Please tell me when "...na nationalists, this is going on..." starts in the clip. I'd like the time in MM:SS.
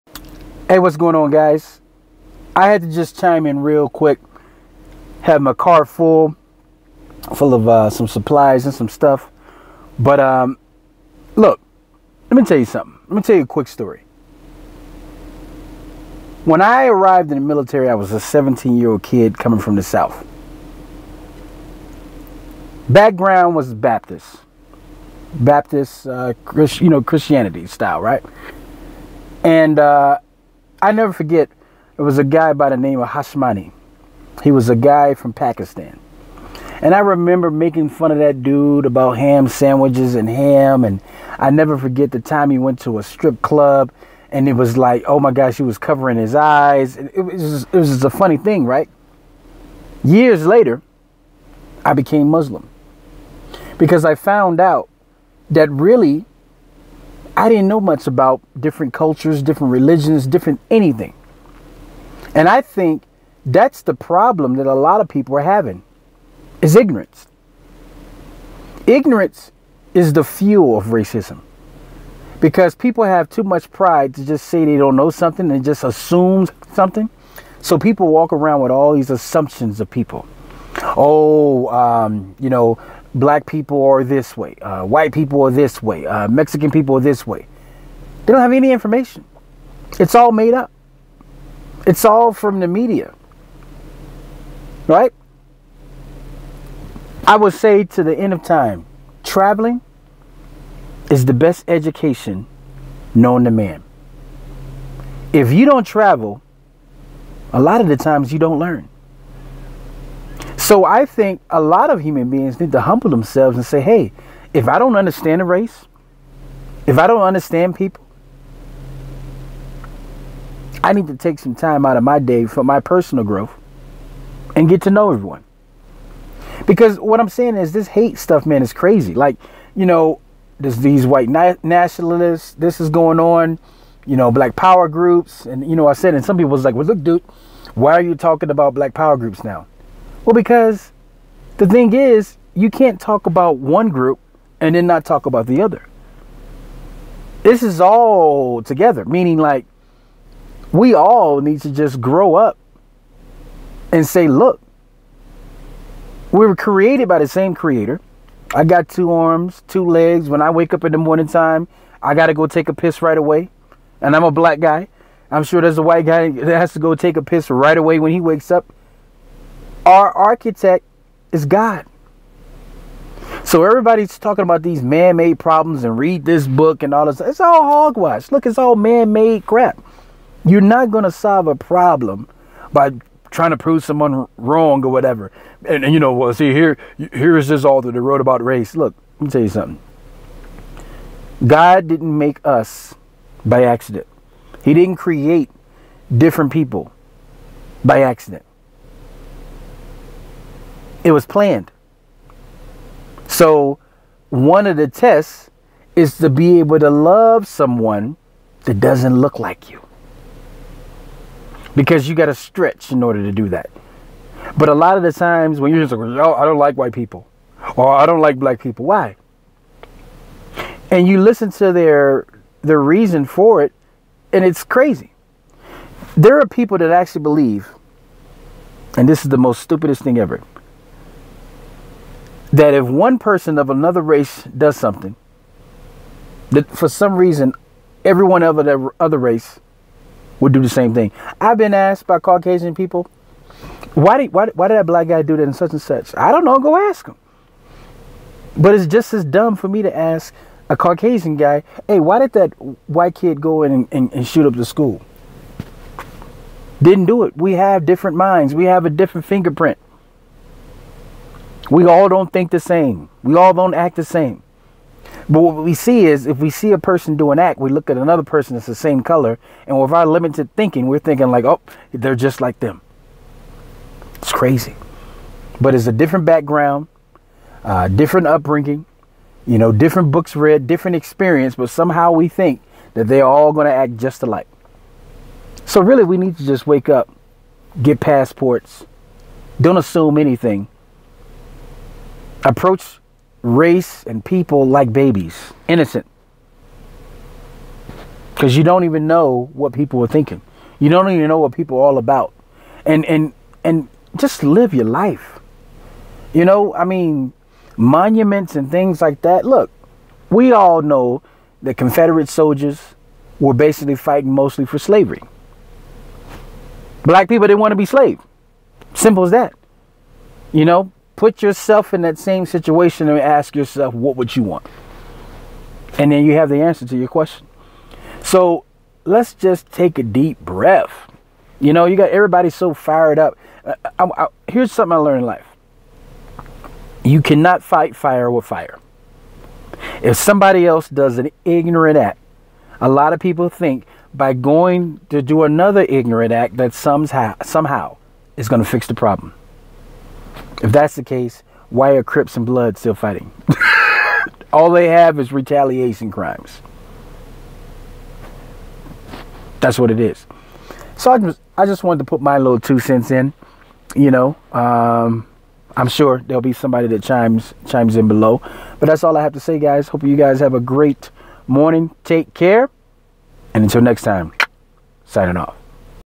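02:11.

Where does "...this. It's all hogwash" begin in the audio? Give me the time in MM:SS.
02:57.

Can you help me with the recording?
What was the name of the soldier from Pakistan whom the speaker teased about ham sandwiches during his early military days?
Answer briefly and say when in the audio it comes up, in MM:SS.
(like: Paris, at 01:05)
Hashmani, at 00:33.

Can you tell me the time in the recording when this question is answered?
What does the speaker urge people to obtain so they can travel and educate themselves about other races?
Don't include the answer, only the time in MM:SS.
04:48.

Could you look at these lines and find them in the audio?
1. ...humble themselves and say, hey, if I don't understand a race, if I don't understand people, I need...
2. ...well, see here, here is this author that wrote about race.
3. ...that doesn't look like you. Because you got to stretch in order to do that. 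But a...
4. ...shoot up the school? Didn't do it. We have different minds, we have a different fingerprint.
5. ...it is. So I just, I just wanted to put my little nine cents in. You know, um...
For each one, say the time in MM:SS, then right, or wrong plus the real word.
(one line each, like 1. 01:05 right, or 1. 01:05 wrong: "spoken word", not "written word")
1. 01:52 right
2. 03:06 right
3. 03:28 right
4. 04:14 right
5. 05:59 wrong: "two", not "nine".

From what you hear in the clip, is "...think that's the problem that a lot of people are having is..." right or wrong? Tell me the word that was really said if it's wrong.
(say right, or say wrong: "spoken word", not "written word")
right.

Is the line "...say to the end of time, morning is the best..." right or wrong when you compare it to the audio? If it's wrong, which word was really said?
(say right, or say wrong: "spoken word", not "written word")
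wrong: "traveling", not "morning".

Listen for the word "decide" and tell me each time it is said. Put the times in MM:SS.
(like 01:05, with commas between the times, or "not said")
not said.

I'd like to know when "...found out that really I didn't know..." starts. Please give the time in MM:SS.
00:54.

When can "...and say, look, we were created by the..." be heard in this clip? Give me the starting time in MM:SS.
02:33.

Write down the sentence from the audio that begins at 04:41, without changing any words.
But somehow we think that they're all going to act just alike.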